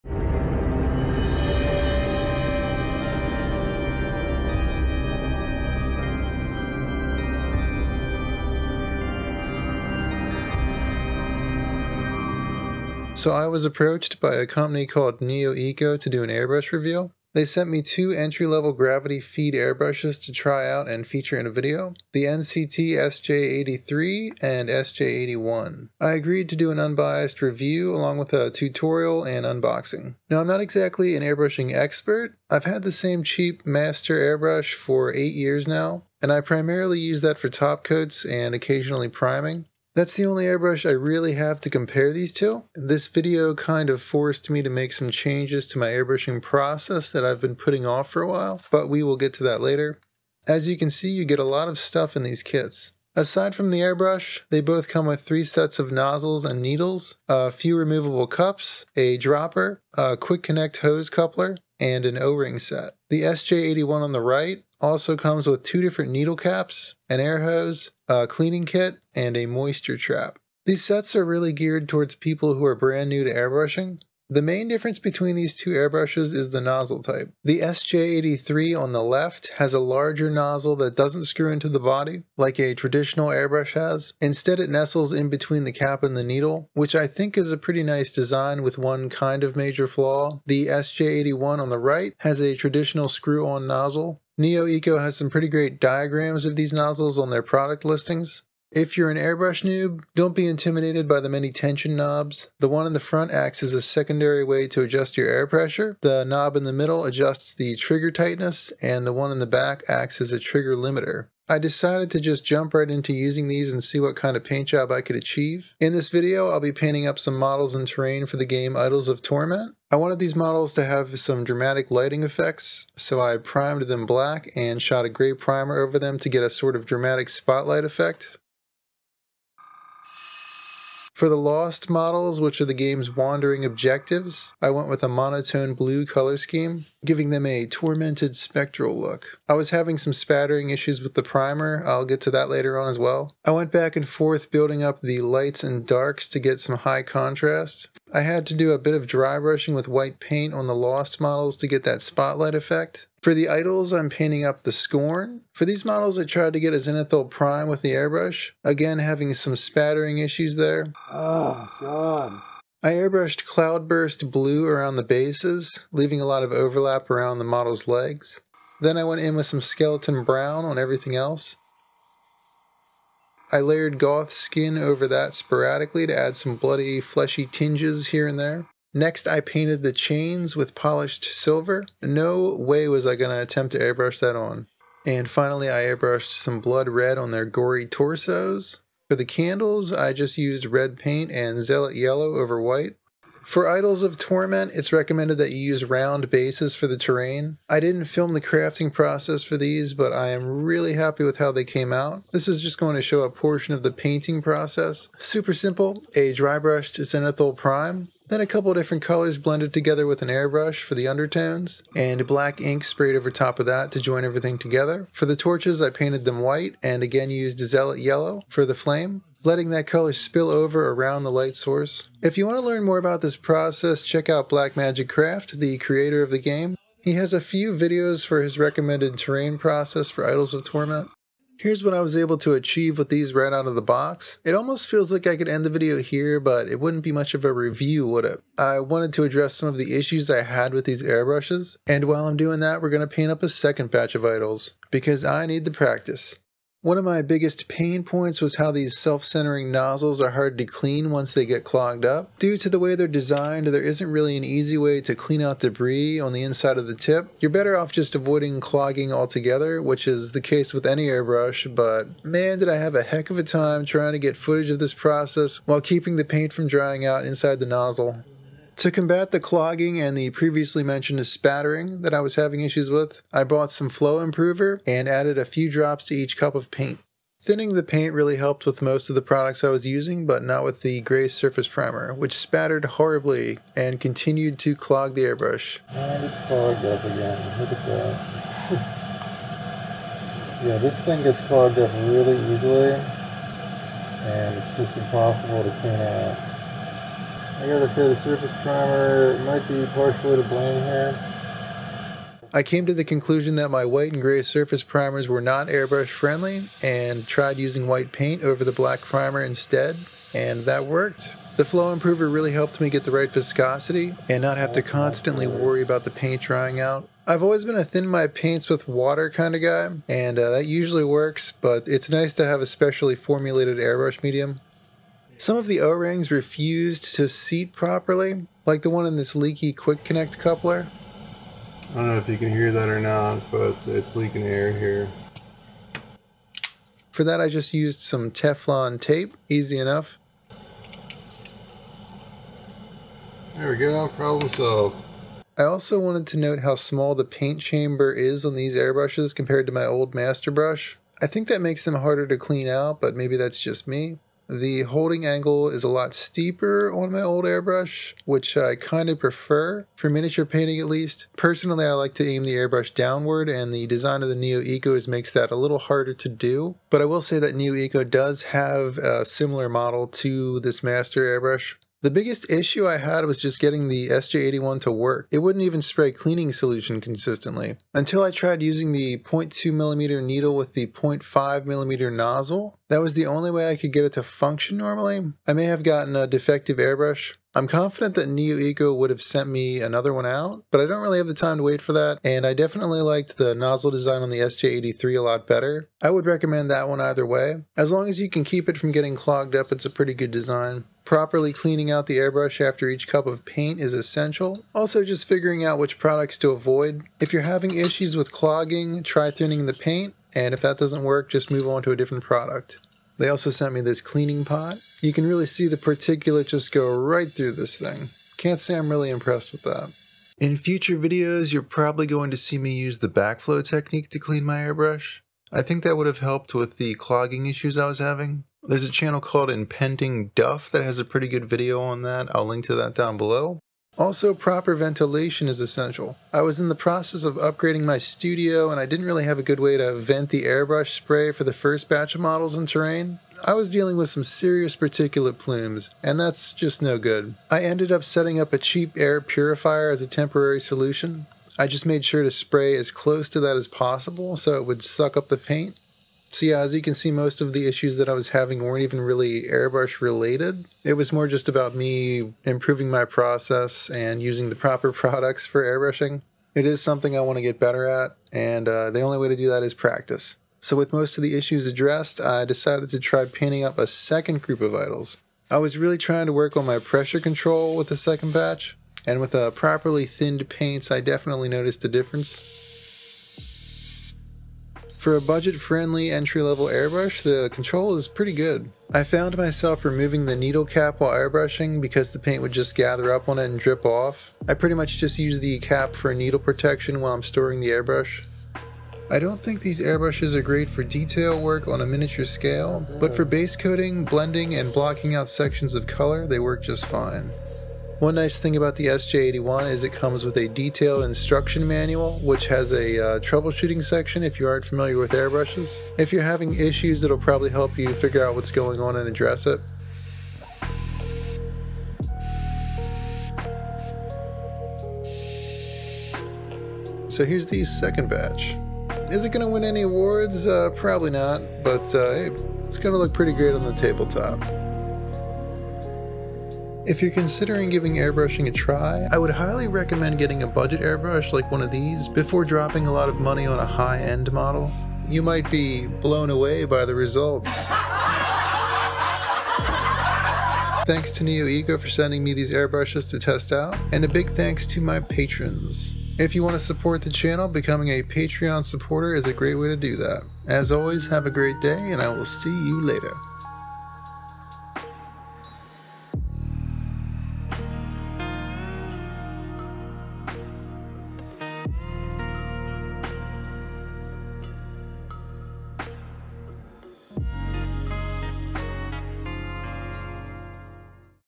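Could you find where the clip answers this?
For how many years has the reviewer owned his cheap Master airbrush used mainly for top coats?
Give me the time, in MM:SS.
00:35.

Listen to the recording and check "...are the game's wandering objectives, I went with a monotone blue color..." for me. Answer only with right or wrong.
right.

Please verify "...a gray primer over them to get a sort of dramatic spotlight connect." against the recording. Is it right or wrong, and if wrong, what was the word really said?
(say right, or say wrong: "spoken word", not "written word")
wrong: "effect", not "connect".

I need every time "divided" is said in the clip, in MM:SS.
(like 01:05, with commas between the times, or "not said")
not said.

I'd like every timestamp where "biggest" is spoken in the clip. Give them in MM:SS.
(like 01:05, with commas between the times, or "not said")
04:07, 06:12.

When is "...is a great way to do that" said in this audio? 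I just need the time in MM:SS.
09:19.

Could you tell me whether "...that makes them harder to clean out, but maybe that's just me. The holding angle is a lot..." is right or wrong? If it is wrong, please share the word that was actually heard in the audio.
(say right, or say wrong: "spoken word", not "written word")
right.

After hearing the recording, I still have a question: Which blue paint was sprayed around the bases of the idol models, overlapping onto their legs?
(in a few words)
Cloudburst blue.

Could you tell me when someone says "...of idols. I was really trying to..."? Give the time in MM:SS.
07:54.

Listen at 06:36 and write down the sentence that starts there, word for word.
I would recommend that one either way.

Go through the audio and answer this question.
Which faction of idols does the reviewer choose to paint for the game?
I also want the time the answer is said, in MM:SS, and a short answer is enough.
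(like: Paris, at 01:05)
the Scorn, at 02:34.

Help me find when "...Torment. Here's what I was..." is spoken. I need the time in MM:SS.
03:50.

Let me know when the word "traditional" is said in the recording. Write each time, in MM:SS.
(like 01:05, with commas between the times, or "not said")
01:22, 01:32.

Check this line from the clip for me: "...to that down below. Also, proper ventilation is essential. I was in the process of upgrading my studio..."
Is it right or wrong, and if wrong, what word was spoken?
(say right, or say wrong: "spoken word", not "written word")
right.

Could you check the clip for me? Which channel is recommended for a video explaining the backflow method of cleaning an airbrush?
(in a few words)
Impending Duff.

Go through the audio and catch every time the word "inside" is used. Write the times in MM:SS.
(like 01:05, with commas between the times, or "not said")
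04:16, 04:27.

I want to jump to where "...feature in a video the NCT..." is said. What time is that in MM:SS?
00:21.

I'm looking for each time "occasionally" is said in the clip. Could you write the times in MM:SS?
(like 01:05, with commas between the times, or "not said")
00:38.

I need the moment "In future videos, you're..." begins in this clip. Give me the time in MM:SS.
07:00.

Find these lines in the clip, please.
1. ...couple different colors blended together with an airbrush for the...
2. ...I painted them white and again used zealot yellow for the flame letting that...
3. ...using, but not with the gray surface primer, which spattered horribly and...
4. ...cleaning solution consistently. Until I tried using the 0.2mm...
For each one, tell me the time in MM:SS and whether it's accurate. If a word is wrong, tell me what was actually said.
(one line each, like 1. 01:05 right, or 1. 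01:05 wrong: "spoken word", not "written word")
1. 03:28 right
2. 03:35 right
3. 04:39 right
4. 06:16 right.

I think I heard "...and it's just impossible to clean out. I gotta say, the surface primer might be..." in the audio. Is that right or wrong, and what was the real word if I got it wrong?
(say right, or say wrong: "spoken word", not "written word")
right.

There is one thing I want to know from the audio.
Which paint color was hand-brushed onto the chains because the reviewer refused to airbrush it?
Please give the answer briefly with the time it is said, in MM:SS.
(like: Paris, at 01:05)
polished silver, at 03:00.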